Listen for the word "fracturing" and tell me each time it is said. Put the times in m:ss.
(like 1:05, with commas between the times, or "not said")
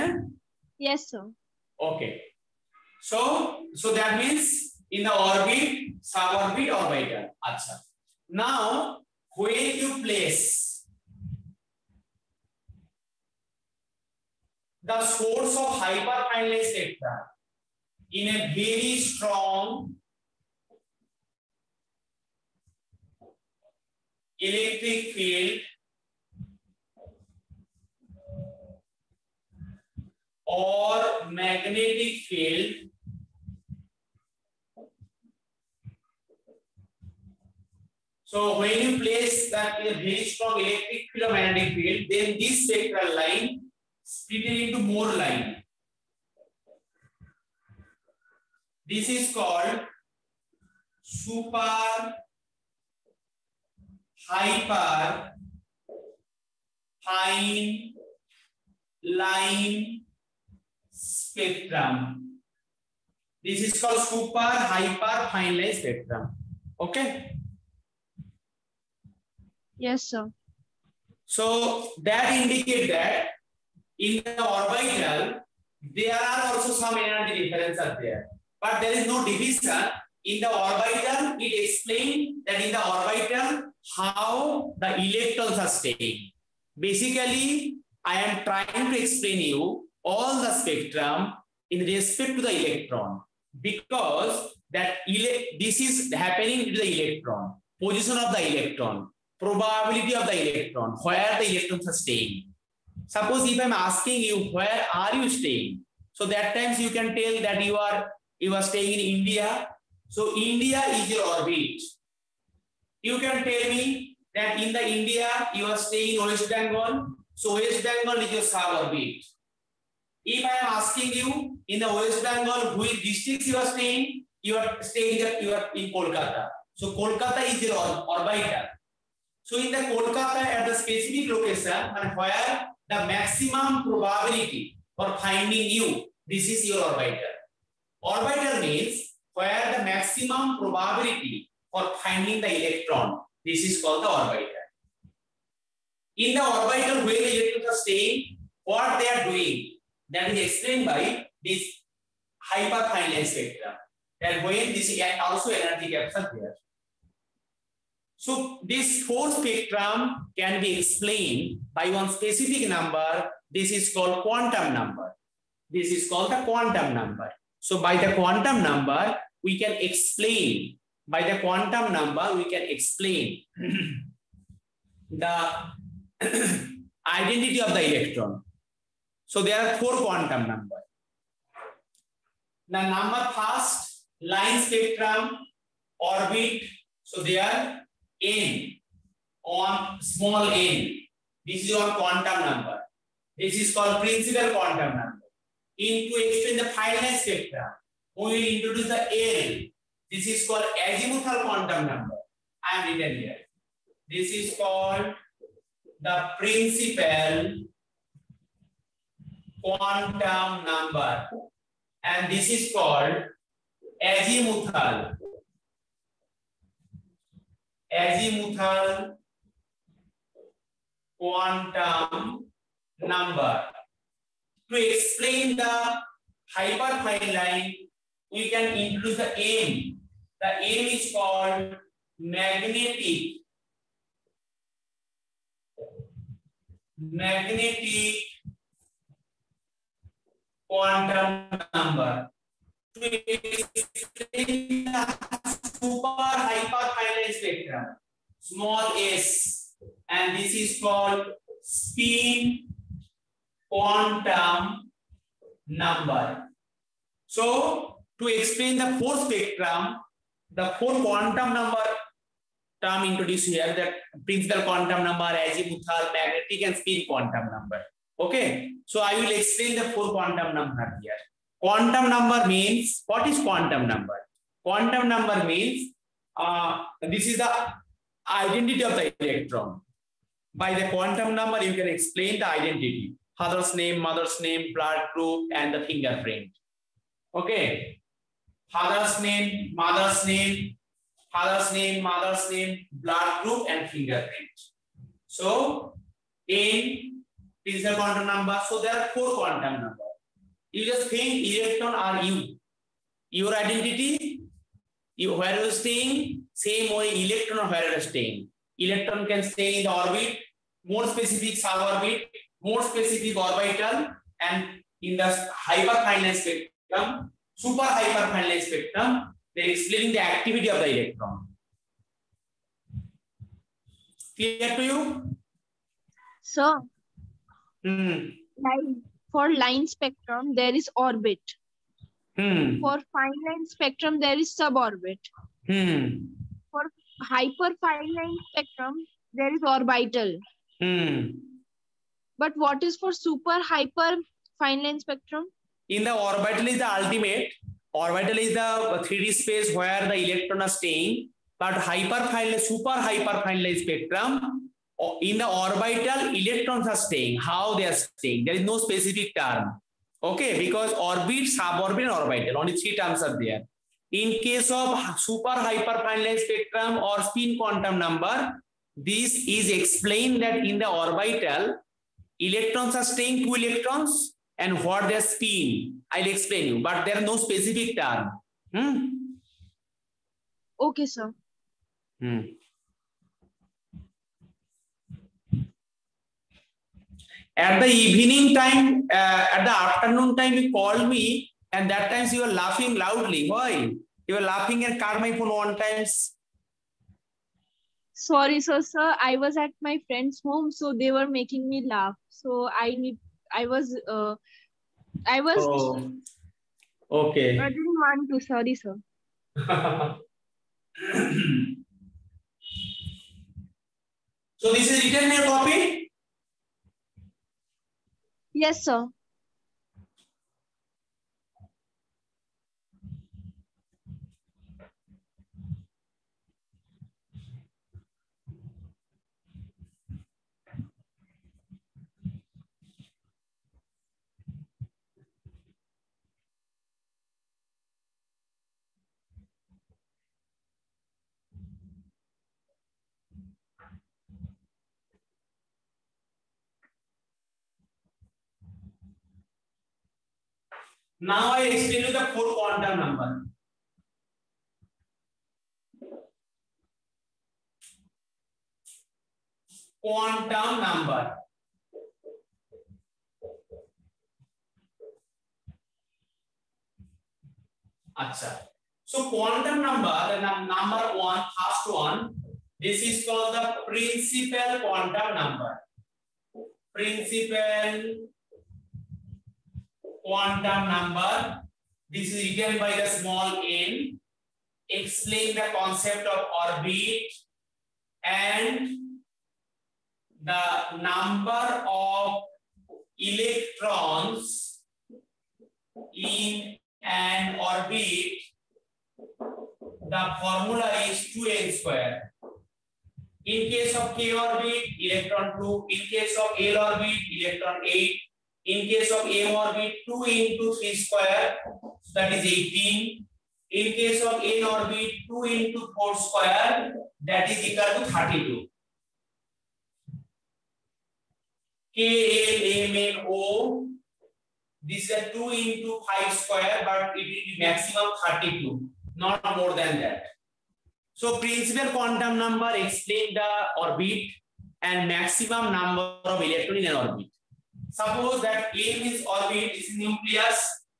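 not said.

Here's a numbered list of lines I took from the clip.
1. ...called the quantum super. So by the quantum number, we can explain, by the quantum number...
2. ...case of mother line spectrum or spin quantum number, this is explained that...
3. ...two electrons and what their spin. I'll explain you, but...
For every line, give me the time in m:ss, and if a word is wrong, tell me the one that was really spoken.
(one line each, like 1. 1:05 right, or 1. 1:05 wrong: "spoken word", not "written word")
1. 2:46 wrong: "number", not "super"
2. 6:04 wrong: "super", not "mother"
3. 6:13 right.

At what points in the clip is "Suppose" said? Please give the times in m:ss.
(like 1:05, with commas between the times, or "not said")
1:43, 8:57.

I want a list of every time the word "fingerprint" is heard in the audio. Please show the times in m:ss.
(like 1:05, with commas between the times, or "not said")
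4:45, 4:53.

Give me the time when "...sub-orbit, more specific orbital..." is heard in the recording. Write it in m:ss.
5:11.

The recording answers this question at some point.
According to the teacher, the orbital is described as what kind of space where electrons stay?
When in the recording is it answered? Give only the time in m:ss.
5:49.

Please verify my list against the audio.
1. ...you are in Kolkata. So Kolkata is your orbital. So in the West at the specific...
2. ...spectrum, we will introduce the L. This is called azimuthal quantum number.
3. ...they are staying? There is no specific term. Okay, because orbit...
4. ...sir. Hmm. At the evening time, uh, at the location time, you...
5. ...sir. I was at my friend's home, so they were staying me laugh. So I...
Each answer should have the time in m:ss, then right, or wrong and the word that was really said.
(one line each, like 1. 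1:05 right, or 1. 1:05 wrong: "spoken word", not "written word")
1. 2:05 wrong: "Kolkata", not "West"
2. 3:17 right
3. 5:57 right
4. 6:21 wrong: "afternoon", not "location"
5. 6:38 wrong: "making", not "staying".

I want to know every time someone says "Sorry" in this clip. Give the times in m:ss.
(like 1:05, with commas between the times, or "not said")
6:38, 6:48.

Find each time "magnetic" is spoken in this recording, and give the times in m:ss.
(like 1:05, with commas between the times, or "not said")
0:31, 0:41, 3:52, 3:57, 4:26.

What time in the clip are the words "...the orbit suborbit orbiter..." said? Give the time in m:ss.
0:05.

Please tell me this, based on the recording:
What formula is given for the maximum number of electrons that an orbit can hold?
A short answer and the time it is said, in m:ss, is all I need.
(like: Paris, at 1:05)
2n square, at 8:21.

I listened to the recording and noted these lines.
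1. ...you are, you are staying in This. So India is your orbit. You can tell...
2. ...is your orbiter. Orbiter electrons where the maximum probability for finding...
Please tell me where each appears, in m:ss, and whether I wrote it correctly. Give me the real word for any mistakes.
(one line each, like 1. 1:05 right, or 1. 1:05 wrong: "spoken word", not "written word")
1. 1:47 wrong: "India", not "This"
2. 2:16 wrong: "means", not "electrons".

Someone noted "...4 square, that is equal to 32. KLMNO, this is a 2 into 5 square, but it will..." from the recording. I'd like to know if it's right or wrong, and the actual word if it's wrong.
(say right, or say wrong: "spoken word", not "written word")
right.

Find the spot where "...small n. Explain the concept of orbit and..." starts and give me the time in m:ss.
8:03.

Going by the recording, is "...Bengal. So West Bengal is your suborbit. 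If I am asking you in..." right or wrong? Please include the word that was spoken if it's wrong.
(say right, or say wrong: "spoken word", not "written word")
right.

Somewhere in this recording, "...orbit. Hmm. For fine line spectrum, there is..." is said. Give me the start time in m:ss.
5:30.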